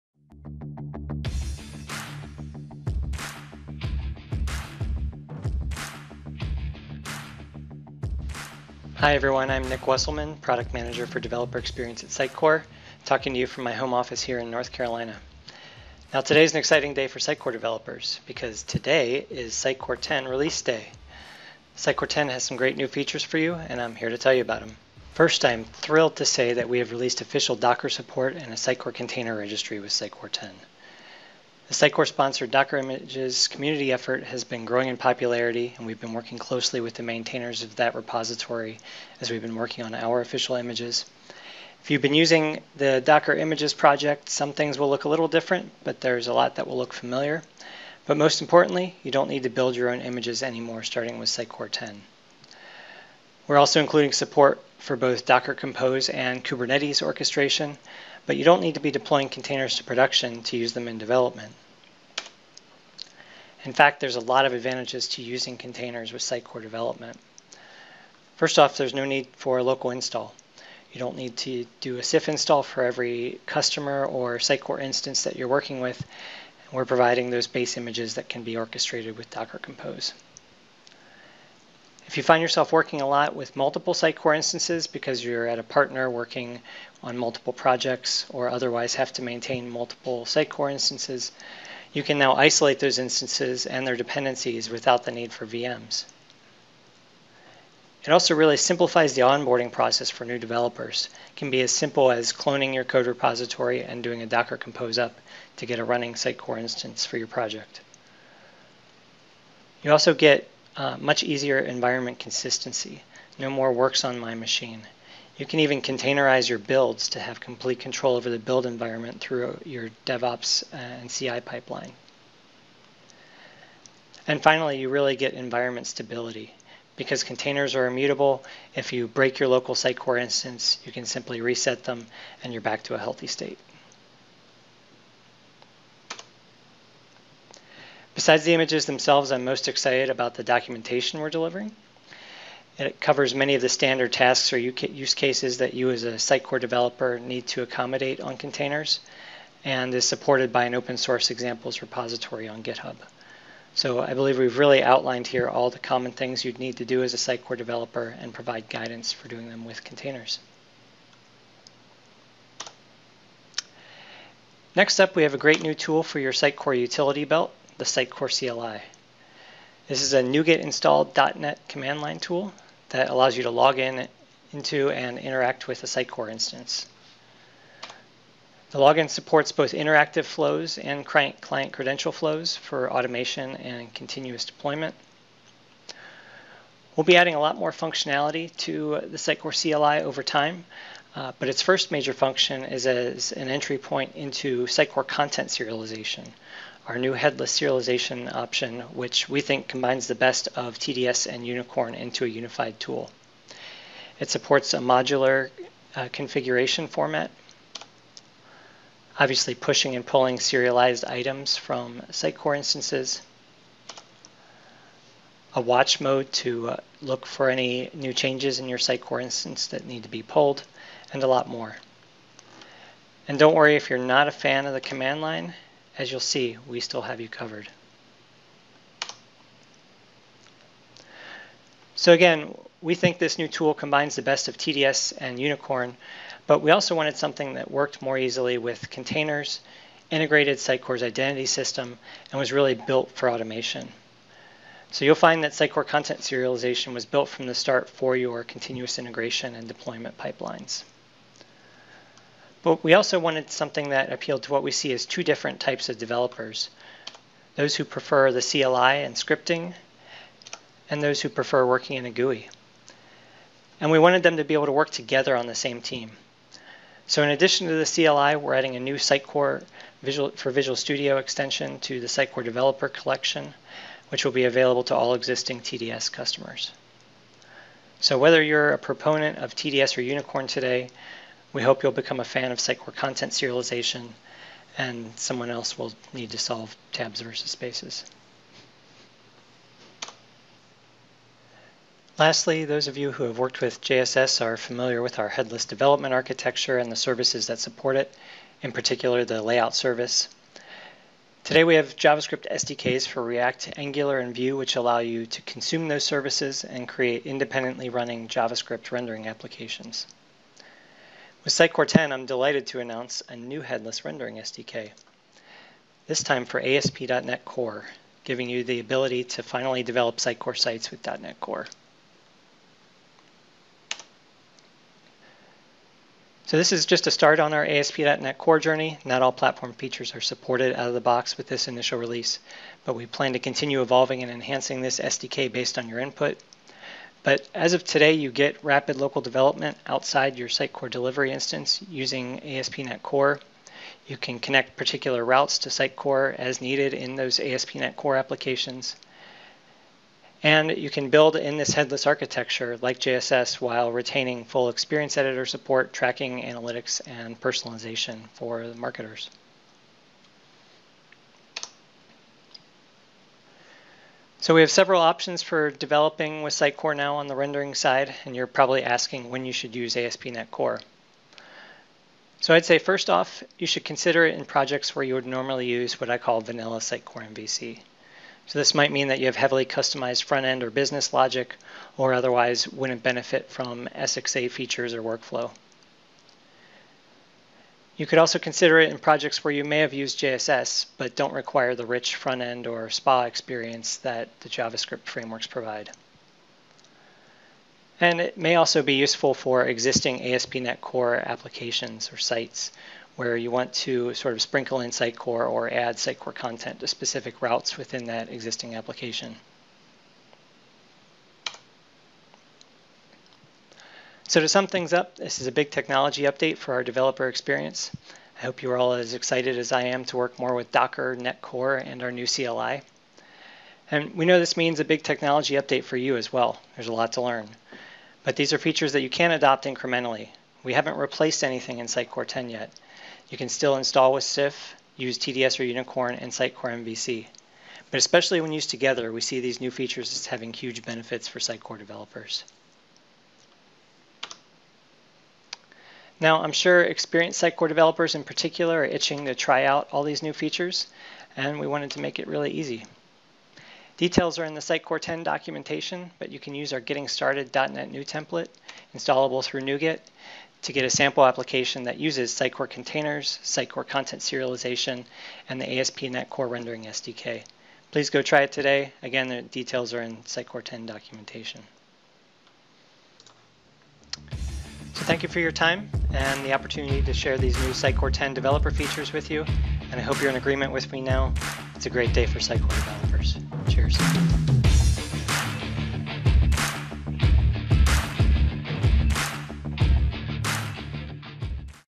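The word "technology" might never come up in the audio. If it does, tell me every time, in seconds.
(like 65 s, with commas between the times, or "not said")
415 s, 425 s.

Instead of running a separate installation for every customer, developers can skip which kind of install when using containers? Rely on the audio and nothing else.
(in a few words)
SIF install.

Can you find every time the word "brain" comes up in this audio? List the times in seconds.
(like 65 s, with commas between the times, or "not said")
not said.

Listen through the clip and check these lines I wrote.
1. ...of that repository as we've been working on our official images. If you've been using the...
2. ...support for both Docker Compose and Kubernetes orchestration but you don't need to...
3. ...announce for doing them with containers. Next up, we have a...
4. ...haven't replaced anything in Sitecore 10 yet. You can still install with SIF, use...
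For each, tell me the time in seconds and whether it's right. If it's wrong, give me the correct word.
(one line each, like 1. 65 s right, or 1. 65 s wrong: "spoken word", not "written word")
1. 37 s right
2. 54 s right
3. 158 s wrong: "guidance", not "announce"
4. 430 s right.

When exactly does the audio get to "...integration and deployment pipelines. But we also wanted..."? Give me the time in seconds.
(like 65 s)
248 s.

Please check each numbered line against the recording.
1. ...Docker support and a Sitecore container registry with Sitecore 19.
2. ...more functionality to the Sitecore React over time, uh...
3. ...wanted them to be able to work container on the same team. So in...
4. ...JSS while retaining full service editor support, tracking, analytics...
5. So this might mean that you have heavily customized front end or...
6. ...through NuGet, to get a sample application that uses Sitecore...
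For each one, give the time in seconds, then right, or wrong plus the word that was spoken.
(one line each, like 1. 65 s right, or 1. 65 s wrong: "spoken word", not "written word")
1. 27 s wrong: "10", not "19"
2. 187 s wrong: "CLI", not "React"
3. 263 s wrong: "together", not "container"
4. 352 s wrong: "experience", not "service"
5. 378 s right
6. 459 s right.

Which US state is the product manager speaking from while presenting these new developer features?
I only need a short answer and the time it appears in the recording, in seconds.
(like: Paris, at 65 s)
North Carolina, at 14 s.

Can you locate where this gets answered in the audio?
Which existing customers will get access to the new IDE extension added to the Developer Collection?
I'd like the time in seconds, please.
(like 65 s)
275 s.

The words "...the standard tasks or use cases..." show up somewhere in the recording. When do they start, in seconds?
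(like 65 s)
143 s.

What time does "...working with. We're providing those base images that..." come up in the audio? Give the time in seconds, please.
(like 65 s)
75 s.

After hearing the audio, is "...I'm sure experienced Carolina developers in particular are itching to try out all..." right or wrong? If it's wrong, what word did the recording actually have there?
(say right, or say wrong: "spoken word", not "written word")
wrong: "Sitecore", not "Carolina".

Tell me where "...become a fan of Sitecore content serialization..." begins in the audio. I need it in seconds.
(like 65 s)
281 s.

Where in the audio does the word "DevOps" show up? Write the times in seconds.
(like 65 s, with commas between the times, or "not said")
120 s.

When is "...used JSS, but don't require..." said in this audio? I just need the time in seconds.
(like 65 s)
389 s.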